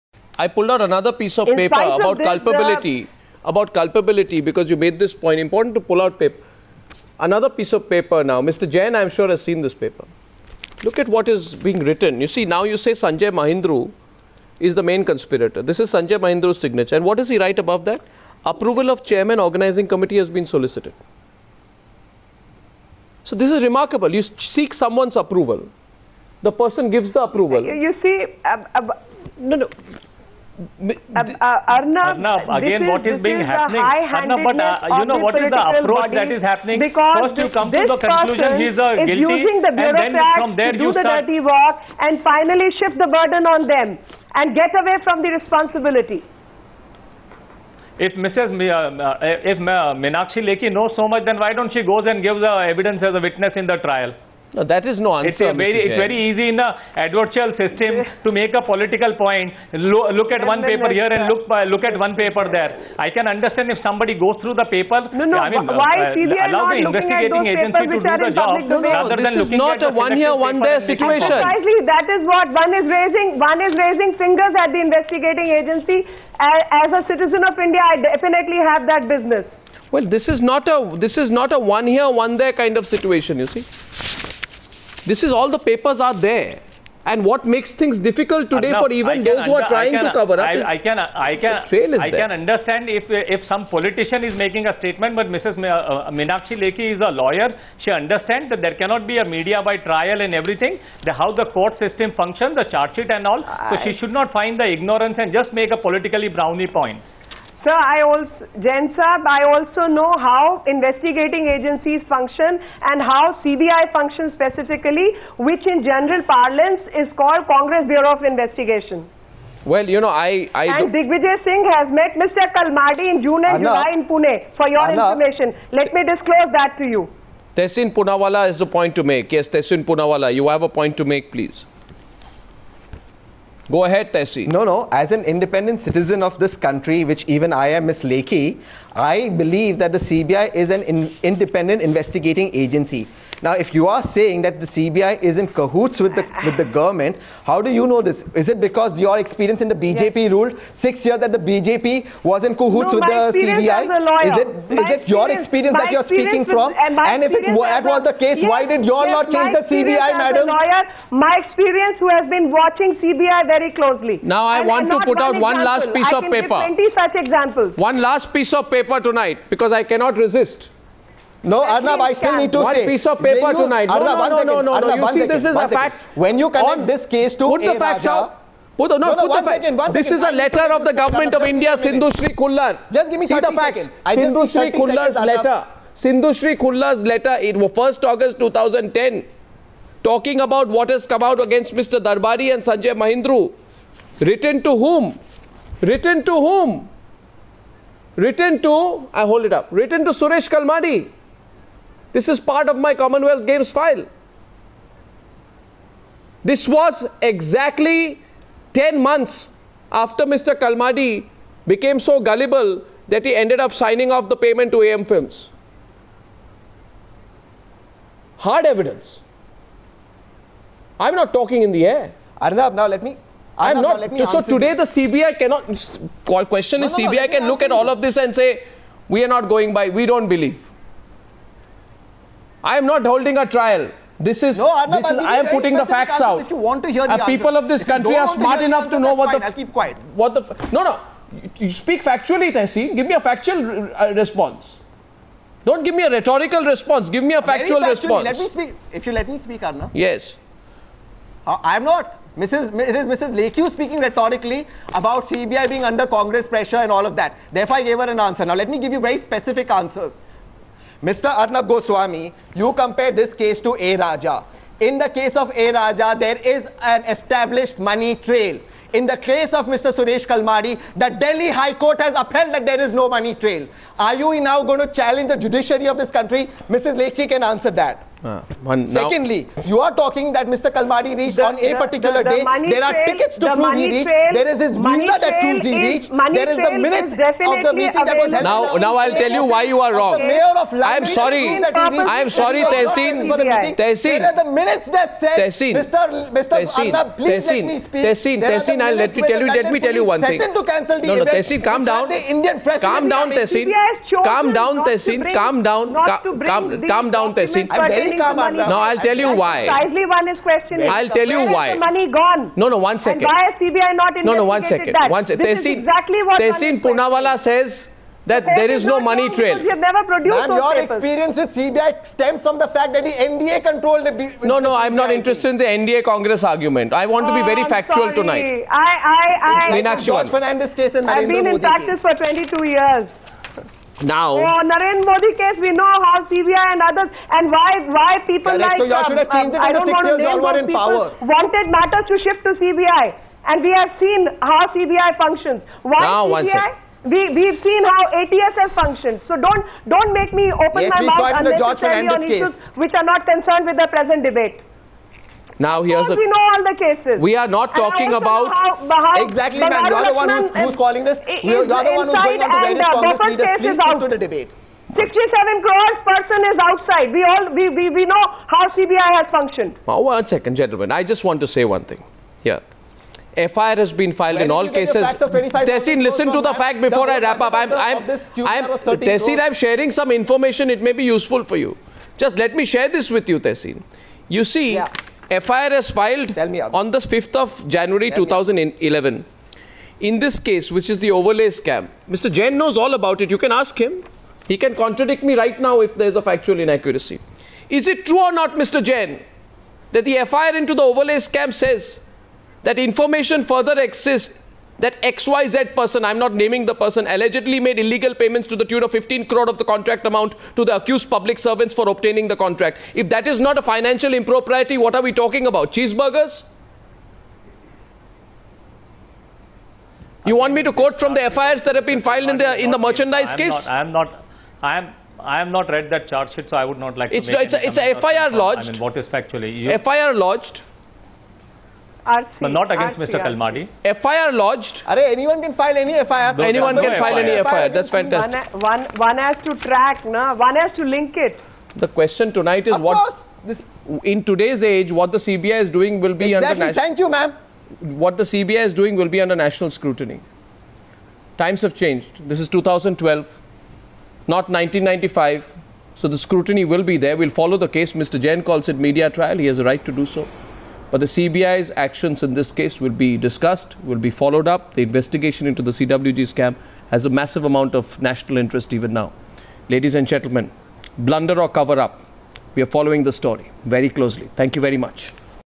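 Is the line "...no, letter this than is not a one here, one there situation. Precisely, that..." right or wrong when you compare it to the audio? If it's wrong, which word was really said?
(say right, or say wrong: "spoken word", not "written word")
wrong: "rather", not "letter".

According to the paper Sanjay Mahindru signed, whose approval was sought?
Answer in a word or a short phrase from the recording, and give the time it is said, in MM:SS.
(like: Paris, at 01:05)
Chairman organizing committee, at 00:19.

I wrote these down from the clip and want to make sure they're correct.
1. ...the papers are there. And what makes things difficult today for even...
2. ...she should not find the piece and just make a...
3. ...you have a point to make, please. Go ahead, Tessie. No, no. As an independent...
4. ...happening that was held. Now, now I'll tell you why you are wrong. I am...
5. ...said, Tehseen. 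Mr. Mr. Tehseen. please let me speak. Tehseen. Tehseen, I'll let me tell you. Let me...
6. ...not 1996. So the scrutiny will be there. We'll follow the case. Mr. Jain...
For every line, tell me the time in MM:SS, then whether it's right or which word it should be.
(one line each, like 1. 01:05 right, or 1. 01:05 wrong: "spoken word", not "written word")
1. 01:25 right
2. 01:43 wrong: "ignorance", not "piece"
3. 02:10 right
4. 04:47 wrong: "meeting", not "happening"
5. 04:55 right
6. 07:34 wrong: "1995", not "1996".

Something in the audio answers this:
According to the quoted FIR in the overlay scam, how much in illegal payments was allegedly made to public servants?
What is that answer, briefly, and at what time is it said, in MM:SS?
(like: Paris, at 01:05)
15 crore, at 06:48.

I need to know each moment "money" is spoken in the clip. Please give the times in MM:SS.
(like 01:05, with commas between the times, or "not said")
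04:27, 04:33, 05:11, 05:18.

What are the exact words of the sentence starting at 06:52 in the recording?
If that is not a financial impropriety, what are we talking about?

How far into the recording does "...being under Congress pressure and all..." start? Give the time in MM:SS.
04:15.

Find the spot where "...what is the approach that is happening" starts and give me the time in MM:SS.
00:35.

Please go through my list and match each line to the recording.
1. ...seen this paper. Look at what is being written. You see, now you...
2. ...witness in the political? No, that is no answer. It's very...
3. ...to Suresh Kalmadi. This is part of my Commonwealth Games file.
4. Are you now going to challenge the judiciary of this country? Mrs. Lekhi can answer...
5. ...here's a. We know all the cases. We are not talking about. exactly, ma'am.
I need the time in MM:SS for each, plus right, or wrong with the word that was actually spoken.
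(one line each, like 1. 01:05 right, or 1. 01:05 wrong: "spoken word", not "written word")
1. 00:09 right
2. 00:53 wrong: "trial", not "political"
3. 03:20 right
4. 04:33 right
5. 05:55 right.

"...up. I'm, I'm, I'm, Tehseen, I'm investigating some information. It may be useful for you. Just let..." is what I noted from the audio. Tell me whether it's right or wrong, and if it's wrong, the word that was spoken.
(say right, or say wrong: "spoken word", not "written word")
wrong: "sharing", not "investigating".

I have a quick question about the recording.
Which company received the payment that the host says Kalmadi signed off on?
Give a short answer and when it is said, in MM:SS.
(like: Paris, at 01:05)
AM Films, at 03:34.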